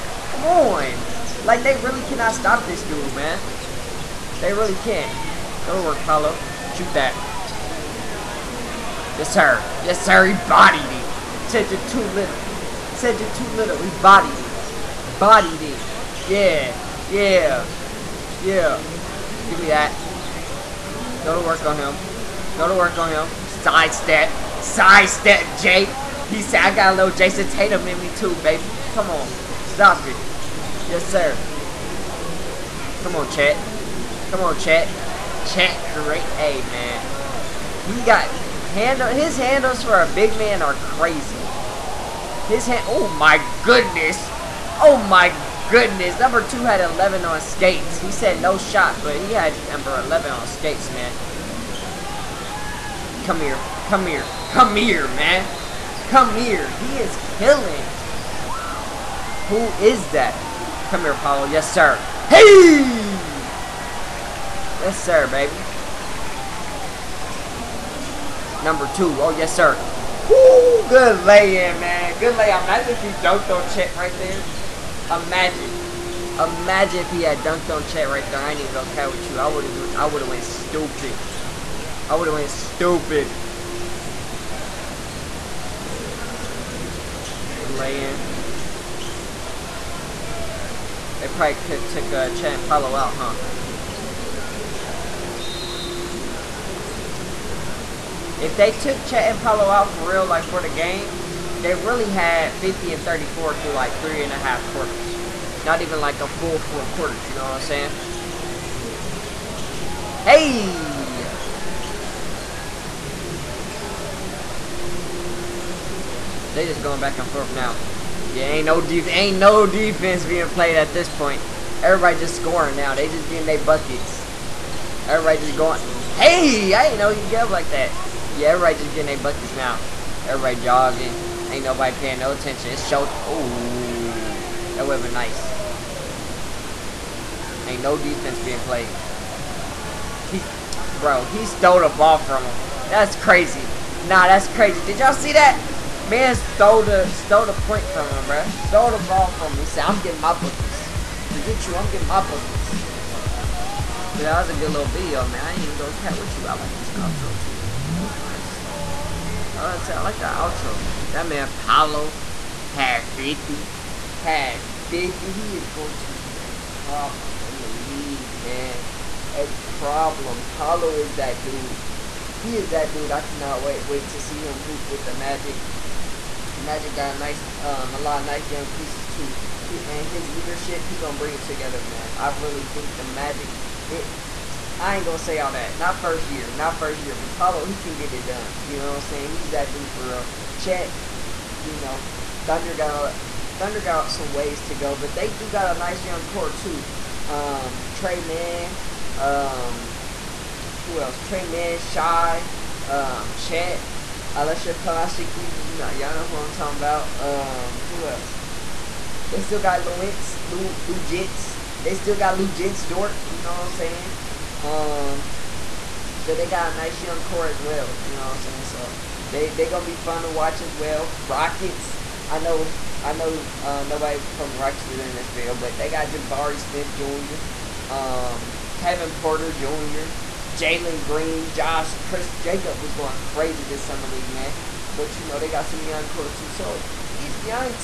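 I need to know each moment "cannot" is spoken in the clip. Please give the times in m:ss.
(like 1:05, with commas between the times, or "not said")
0:02, 2:53.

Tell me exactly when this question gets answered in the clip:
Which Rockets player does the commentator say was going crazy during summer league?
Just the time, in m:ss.
3:51.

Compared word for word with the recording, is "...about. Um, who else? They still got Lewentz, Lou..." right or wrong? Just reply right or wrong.
right.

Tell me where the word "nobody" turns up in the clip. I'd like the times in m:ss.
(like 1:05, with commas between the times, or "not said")
2:11, 3:43.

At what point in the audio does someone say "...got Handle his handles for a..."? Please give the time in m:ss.
0:38.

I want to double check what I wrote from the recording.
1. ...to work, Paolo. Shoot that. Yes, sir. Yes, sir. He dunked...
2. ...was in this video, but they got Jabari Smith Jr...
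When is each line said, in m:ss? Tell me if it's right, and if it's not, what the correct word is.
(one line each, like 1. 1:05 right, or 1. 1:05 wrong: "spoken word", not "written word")
1. 0:05 wrong: "bodied", not "dunked"
2. 3:44 right.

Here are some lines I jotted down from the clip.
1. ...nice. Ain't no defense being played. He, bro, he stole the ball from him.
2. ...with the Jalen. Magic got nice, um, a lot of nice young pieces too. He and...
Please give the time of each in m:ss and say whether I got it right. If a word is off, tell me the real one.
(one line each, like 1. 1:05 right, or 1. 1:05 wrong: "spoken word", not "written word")
1. 2:15 right
2. 2:54 wrong: "Magic", not "Jalen".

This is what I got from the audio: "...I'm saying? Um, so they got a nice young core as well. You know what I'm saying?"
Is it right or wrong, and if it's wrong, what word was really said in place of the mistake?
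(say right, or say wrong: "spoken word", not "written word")
right.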